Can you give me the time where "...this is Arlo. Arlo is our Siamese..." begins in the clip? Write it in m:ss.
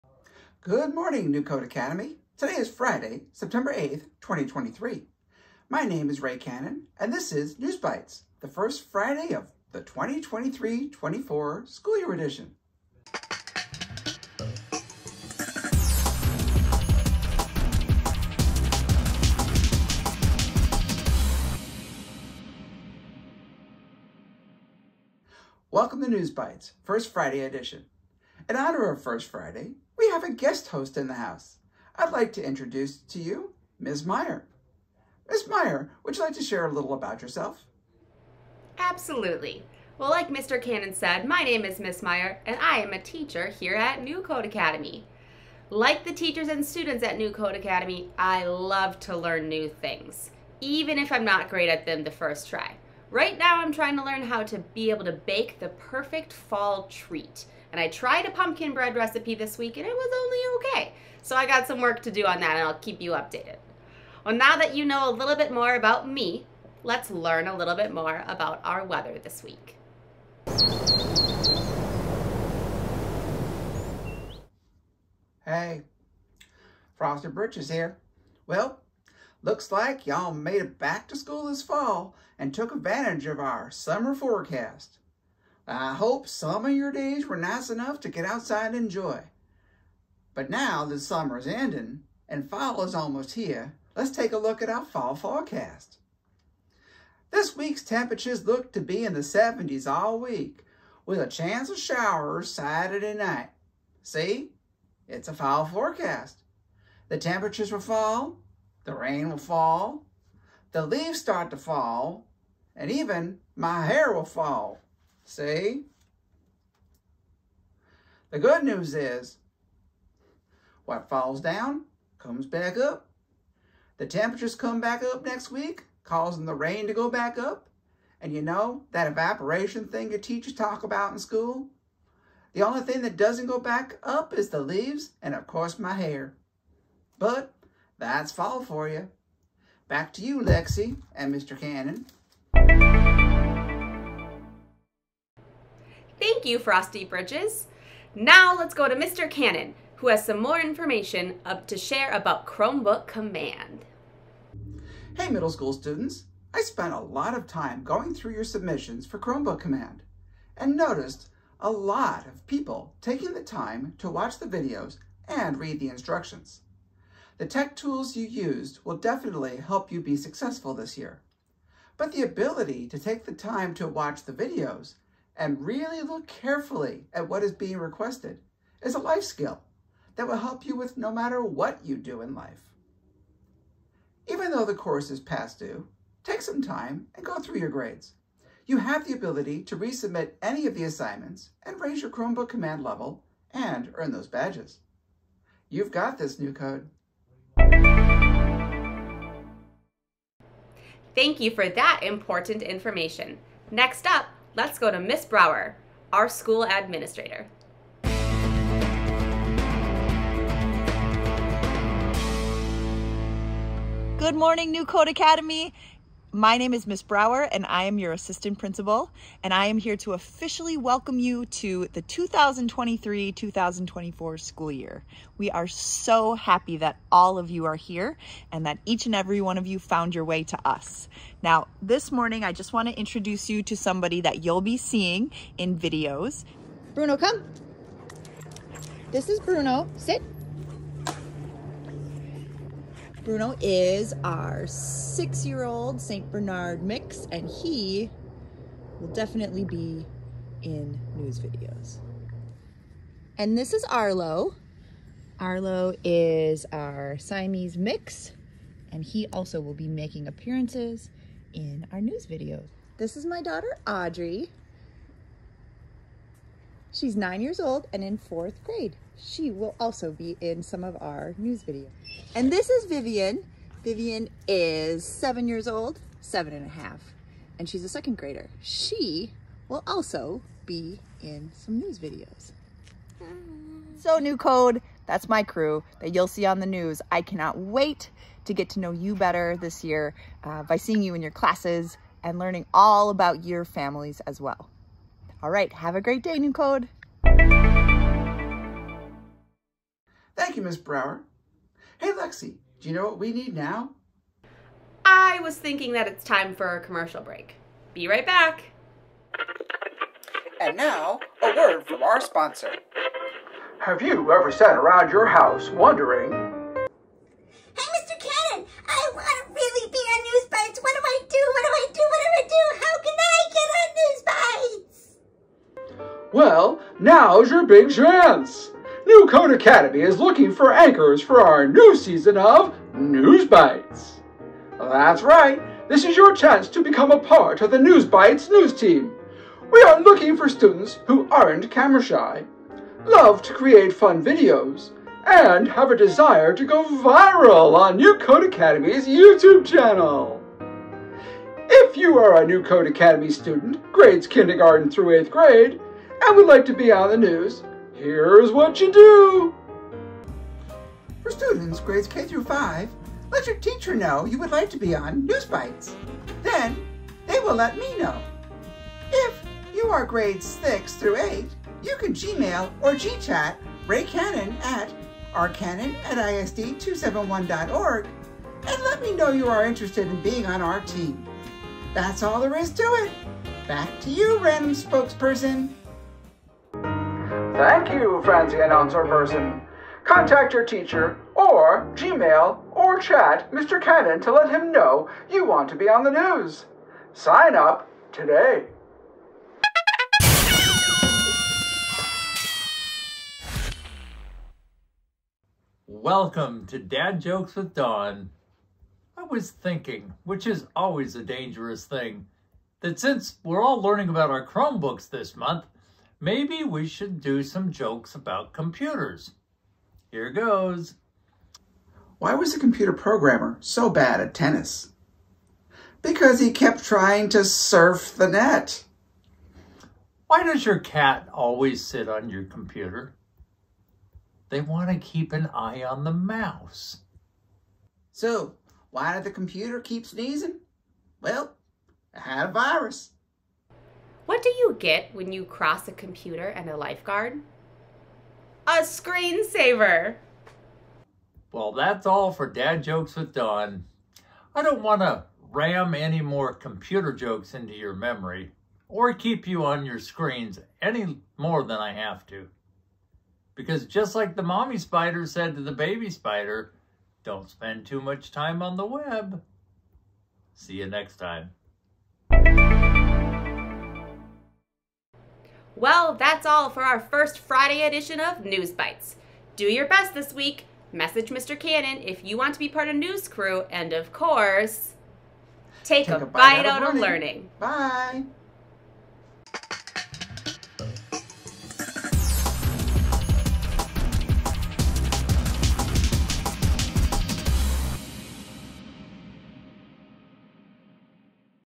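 4:13.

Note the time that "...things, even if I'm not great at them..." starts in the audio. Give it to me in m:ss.
0:49.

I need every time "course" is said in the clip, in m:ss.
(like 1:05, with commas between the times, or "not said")
2:15, 3:04, 8:04.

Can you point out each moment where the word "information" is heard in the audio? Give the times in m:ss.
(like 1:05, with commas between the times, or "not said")
2:30, 3:22.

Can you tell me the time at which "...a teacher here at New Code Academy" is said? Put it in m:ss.
0:42.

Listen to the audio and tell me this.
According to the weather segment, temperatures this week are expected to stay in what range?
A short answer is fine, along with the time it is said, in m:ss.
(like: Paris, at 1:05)
70s, at 1:39.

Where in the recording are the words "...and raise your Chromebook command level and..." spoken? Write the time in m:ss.
3:11.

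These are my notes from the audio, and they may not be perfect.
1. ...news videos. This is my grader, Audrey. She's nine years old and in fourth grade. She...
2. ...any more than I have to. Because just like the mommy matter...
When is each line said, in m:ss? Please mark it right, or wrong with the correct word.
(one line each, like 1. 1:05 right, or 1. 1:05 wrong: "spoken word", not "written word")
1. 4:22 wrong: "daughter", not "grader"
2. 7:40 wrong: "spider", not "matter".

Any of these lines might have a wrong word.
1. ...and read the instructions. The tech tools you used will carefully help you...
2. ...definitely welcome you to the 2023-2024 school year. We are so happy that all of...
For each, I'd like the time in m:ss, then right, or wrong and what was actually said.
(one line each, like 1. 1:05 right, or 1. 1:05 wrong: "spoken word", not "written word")
1. 2:45 wrong: "definitely", not "carefully"
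2. 3:40 wrong: "officially", not "definitely".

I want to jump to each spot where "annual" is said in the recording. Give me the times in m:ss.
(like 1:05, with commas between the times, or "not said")
not said.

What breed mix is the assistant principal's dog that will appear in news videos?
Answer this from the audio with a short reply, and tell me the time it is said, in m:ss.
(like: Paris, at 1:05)
St. Bernard mix, at 4:06.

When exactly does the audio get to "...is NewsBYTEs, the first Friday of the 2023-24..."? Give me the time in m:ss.
0:07.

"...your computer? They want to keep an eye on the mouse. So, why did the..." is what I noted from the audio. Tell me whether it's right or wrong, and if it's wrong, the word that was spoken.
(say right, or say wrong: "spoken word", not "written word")
right.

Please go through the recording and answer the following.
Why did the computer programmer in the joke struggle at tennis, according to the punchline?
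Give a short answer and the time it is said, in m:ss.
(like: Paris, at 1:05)
Trying to surf the net, at 7:07.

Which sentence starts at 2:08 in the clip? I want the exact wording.
And you know, that evaporation thing your teachers talk about in school?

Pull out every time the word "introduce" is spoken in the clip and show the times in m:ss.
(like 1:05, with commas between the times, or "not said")
0:32, 3:52.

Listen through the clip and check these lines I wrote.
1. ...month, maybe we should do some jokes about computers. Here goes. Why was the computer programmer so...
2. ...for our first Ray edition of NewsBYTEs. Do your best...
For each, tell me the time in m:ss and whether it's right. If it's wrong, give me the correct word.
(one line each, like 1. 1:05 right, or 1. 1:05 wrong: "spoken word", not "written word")
1. 6:55 right
2. 7:56 wrong: "Friday", not "Ray".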